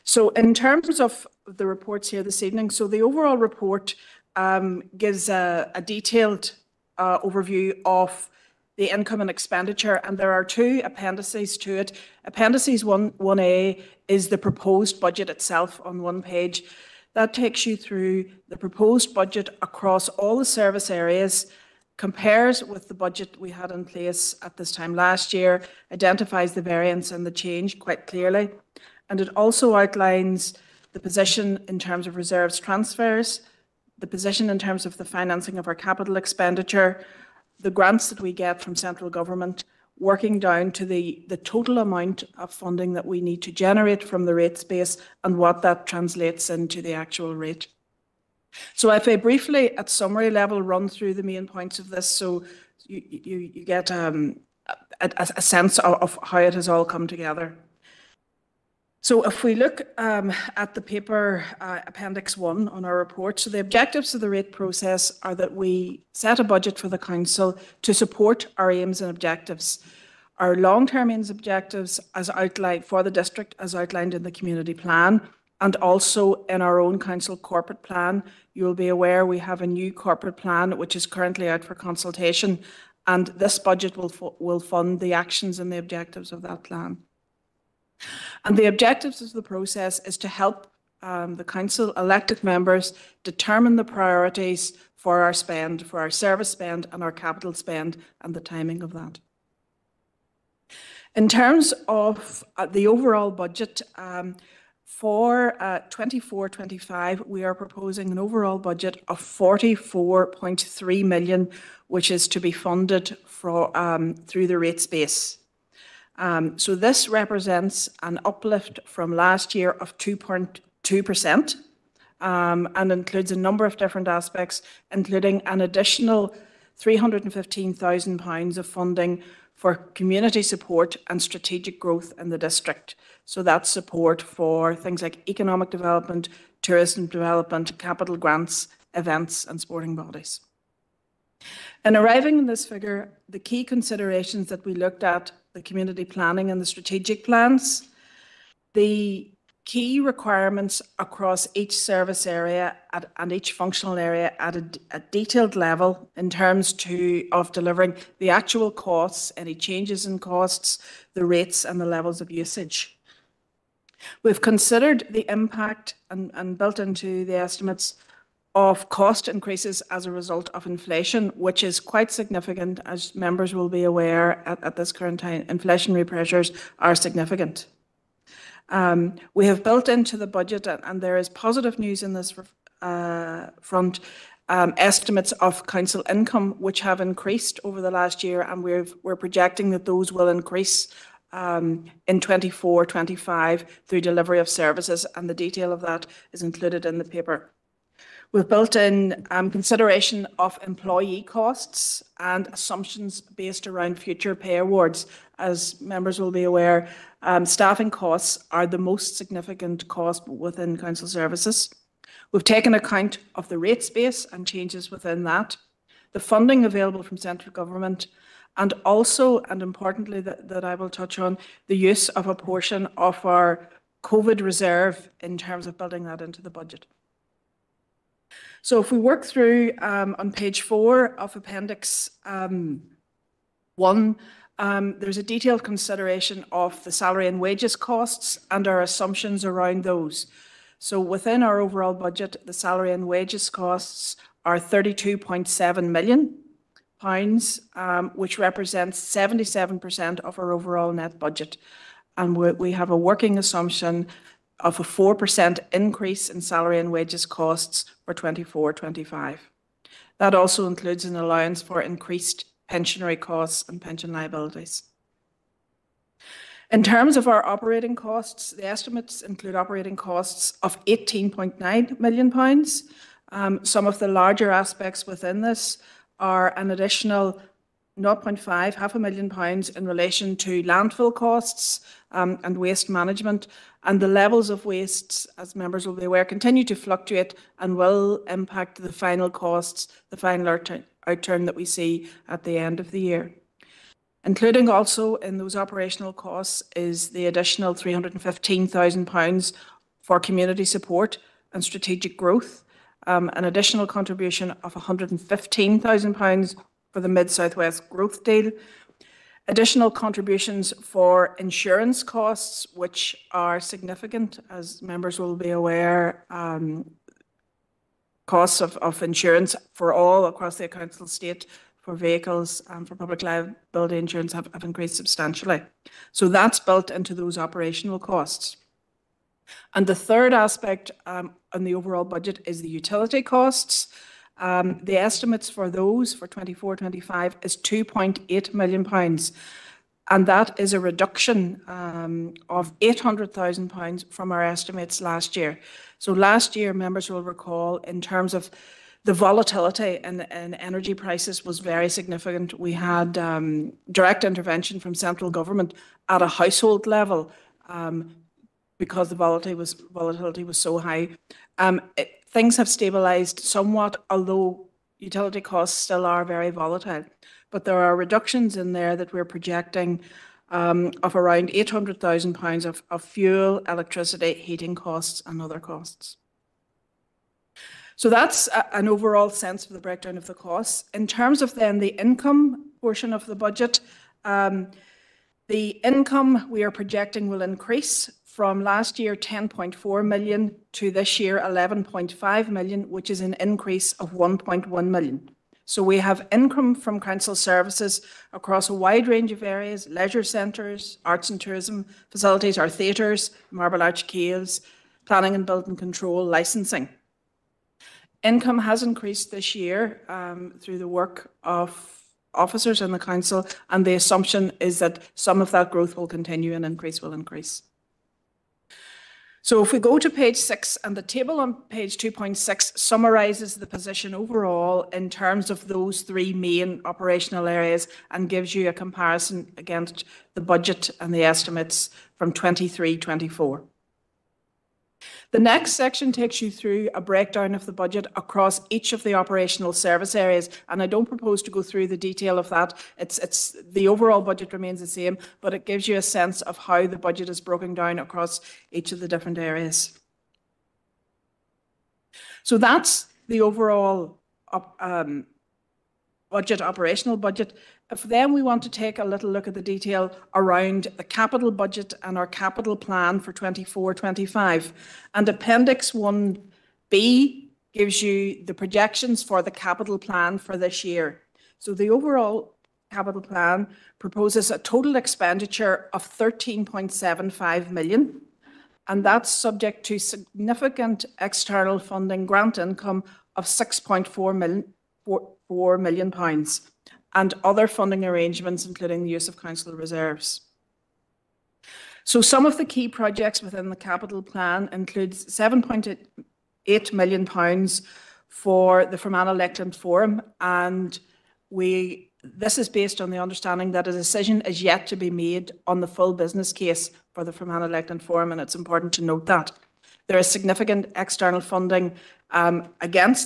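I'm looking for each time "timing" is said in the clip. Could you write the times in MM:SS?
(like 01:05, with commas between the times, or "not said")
01:38.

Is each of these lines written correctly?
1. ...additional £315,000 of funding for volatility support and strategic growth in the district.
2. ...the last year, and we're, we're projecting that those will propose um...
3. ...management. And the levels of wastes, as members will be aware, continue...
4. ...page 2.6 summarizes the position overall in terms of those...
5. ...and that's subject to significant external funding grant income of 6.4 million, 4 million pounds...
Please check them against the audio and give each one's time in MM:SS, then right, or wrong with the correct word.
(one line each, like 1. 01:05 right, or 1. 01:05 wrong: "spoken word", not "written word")
1. 02:05 wrong: "community", not "volatility"
2. 03:07 wrong: "increase", not "propose"
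3. 04:42 right
4. 07:01 right
5. 07:58 right.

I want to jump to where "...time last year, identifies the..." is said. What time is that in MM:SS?
00:24.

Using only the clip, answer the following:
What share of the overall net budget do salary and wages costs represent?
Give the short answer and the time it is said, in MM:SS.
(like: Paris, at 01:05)
77%, at 04:08.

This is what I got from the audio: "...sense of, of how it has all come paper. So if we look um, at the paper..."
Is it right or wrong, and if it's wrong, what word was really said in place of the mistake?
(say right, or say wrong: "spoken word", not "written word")
wrong: "together", not "paper".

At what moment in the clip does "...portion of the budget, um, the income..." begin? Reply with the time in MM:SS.
06:22.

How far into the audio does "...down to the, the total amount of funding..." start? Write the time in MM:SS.
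00:40.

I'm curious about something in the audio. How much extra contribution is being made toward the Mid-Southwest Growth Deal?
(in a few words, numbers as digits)
£115,000.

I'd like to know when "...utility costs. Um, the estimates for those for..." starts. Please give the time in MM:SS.
05:32.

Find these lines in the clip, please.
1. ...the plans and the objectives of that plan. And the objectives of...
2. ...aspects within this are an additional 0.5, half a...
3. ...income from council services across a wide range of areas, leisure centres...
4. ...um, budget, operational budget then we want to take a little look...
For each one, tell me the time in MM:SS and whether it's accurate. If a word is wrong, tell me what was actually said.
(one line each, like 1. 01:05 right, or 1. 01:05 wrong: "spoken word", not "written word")
1. 01:24 wrong: "actions", not "plans"
2. 04:34 right
3. 06:36 right
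4. 07:34 right.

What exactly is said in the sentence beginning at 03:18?
We've built in um, consideration of employee costs and assumptions based around future pay awards.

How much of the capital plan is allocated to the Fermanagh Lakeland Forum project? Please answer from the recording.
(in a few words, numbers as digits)
£7.8 million.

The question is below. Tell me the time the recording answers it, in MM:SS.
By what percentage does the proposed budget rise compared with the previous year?
01:59.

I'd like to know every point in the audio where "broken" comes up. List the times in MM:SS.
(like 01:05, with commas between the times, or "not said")
07:27.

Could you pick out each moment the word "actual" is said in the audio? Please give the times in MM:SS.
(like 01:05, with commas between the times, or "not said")
00:46, 02:38.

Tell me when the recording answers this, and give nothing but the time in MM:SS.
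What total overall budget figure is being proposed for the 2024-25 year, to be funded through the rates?
01:49.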